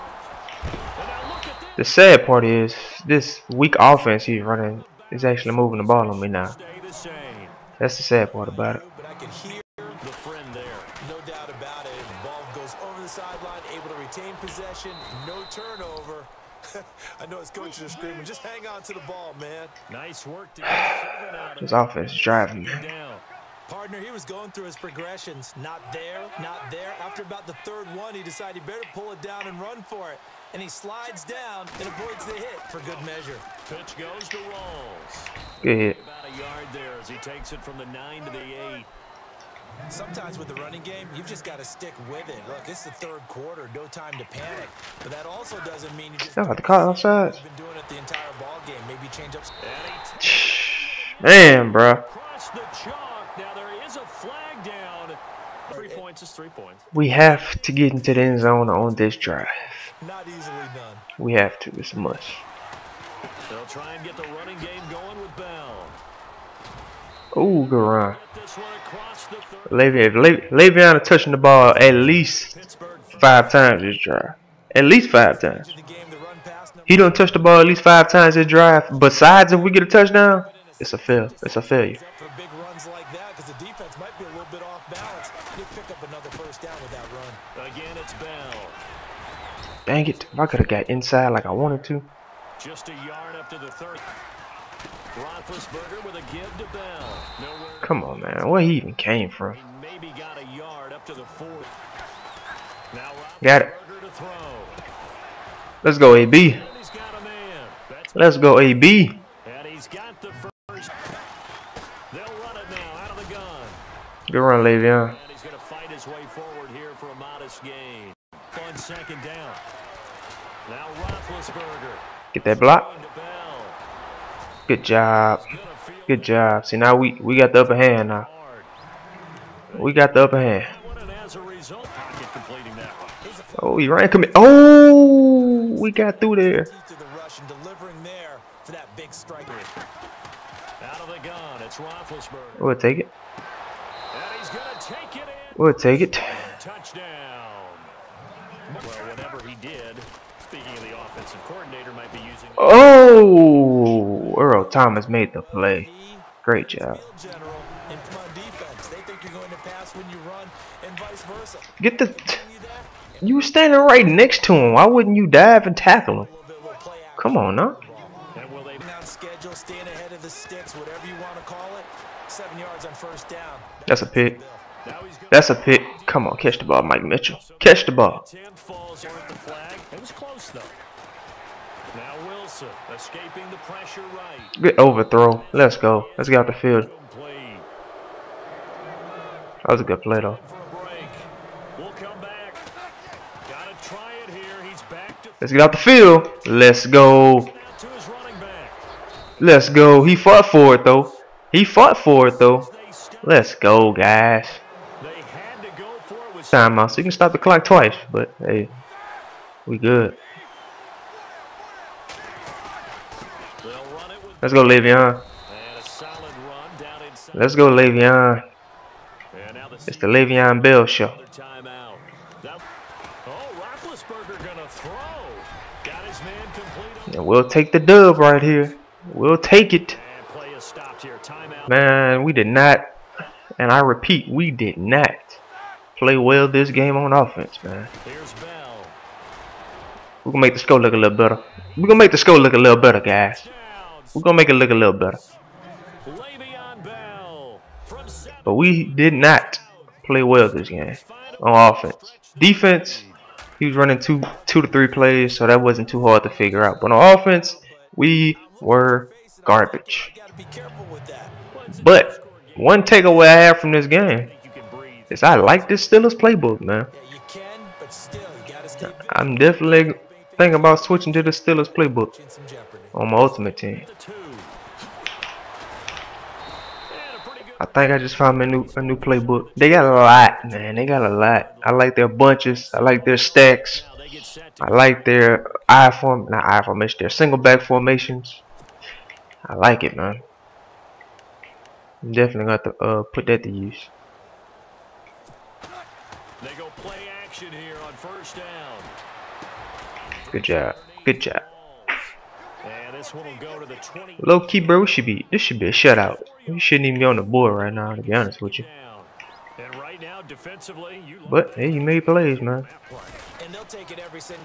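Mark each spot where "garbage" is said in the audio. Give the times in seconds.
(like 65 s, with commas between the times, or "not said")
259 s.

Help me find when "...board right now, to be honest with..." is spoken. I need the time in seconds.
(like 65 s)
307 s.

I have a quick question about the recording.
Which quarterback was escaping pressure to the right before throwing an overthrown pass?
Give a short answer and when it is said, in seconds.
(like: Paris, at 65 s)
Nelson, at 182 s.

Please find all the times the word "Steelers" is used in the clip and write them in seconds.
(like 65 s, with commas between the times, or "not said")
265 s, 271 s.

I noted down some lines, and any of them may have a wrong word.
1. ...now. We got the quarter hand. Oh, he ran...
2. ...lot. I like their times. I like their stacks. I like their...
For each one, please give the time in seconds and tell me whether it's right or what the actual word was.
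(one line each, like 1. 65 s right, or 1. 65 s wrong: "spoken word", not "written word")
1. 128 s wrong: "upper", not "quarter"
2. 281 s wrong: "bunches", not "times".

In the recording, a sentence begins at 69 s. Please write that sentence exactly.
Le'Veon, touching the ball at least five times this drive.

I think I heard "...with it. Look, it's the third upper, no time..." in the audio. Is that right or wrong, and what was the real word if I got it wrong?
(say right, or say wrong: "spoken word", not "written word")
wrong: "quarter", not "upper".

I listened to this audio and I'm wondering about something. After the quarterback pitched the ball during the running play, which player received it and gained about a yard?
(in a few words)
Rawls.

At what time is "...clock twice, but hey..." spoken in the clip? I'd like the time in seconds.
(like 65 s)
207 s.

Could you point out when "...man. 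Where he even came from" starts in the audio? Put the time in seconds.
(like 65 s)
98 s.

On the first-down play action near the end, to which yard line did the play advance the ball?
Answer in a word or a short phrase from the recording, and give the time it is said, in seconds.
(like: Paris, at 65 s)
20, at 303 s.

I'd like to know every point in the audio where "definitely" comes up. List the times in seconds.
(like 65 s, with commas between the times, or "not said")
269 s, 292 s.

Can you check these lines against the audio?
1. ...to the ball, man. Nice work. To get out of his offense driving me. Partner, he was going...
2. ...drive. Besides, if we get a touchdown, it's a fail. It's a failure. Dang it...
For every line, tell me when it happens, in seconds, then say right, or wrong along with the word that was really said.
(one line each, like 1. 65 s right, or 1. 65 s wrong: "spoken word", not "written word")
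1. 18 s right
2. 78 s right.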